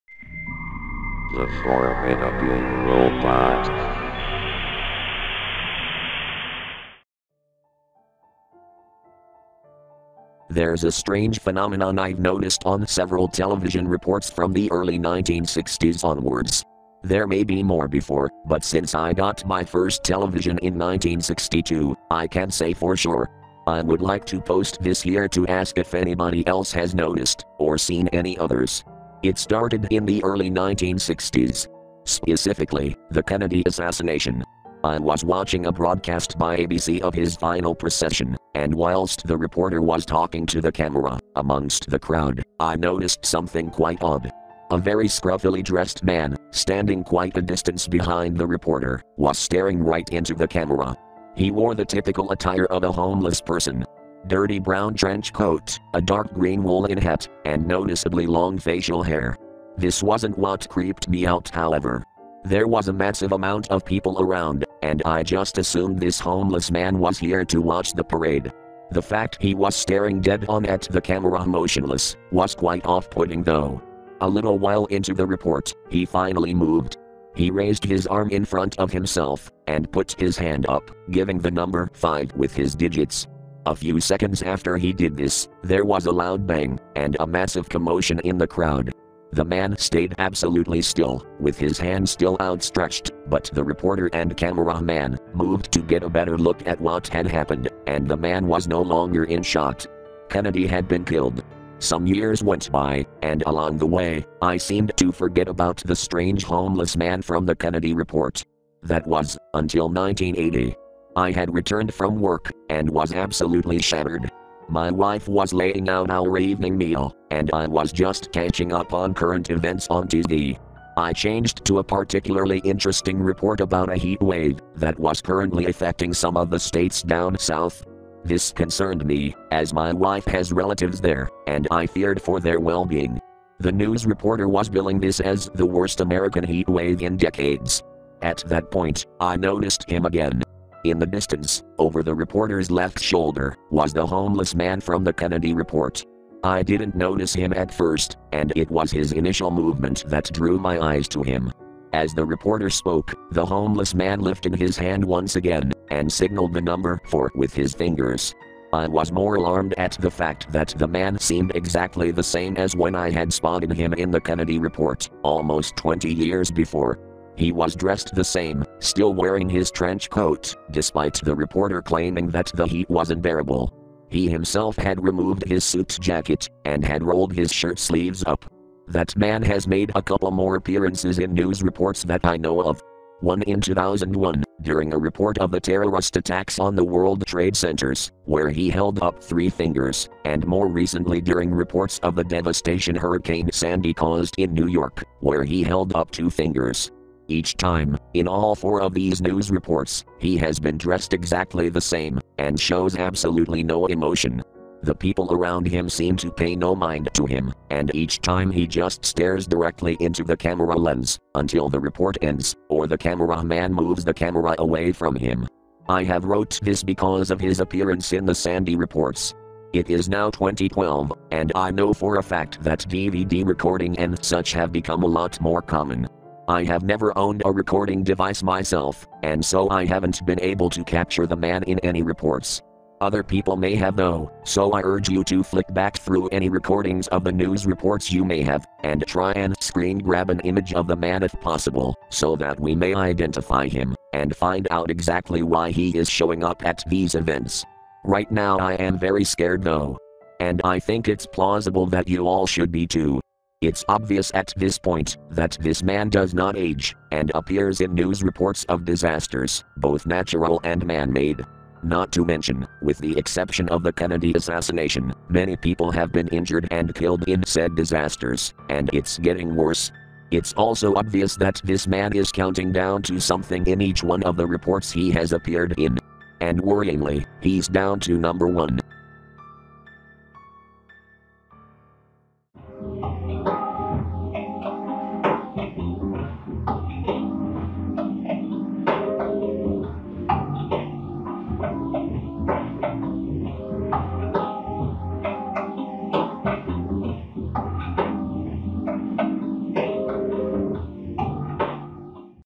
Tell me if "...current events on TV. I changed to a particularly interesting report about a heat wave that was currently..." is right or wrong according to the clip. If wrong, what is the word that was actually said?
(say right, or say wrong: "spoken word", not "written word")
right.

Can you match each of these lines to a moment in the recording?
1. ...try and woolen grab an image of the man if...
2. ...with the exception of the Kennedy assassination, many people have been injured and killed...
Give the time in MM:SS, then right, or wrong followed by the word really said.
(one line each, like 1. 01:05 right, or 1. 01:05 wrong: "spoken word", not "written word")
1. 03:59 wrong: "screen", not "woolen"
2. 04:22 right.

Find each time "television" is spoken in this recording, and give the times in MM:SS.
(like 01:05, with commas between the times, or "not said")
00:13, 00:20.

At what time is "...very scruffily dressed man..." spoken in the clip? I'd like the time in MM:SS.
00:44.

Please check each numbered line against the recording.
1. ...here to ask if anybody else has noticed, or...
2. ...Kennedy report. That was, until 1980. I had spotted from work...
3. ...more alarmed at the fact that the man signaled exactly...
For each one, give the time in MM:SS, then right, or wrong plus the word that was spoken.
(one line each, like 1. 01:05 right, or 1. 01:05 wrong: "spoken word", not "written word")
1. 00:25 right
2. 01:47 wrong: "returned", not "spotted"
3. 02:39 wrong: "seemed", not "signaled".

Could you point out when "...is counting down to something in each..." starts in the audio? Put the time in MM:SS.
04:32.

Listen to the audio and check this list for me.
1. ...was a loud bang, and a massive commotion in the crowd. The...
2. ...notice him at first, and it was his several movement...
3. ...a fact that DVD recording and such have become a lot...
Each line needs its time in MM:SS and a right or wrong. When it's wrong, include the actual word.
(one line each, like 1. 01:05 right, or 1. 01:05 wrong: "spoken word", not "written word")
1. 01:25 right
2. 02:26 wrong: "initial", not "several"
3. 03:42 right.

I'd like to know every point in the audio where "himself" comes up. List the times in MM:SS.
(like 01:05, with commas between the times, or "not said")
01:18, 02:54.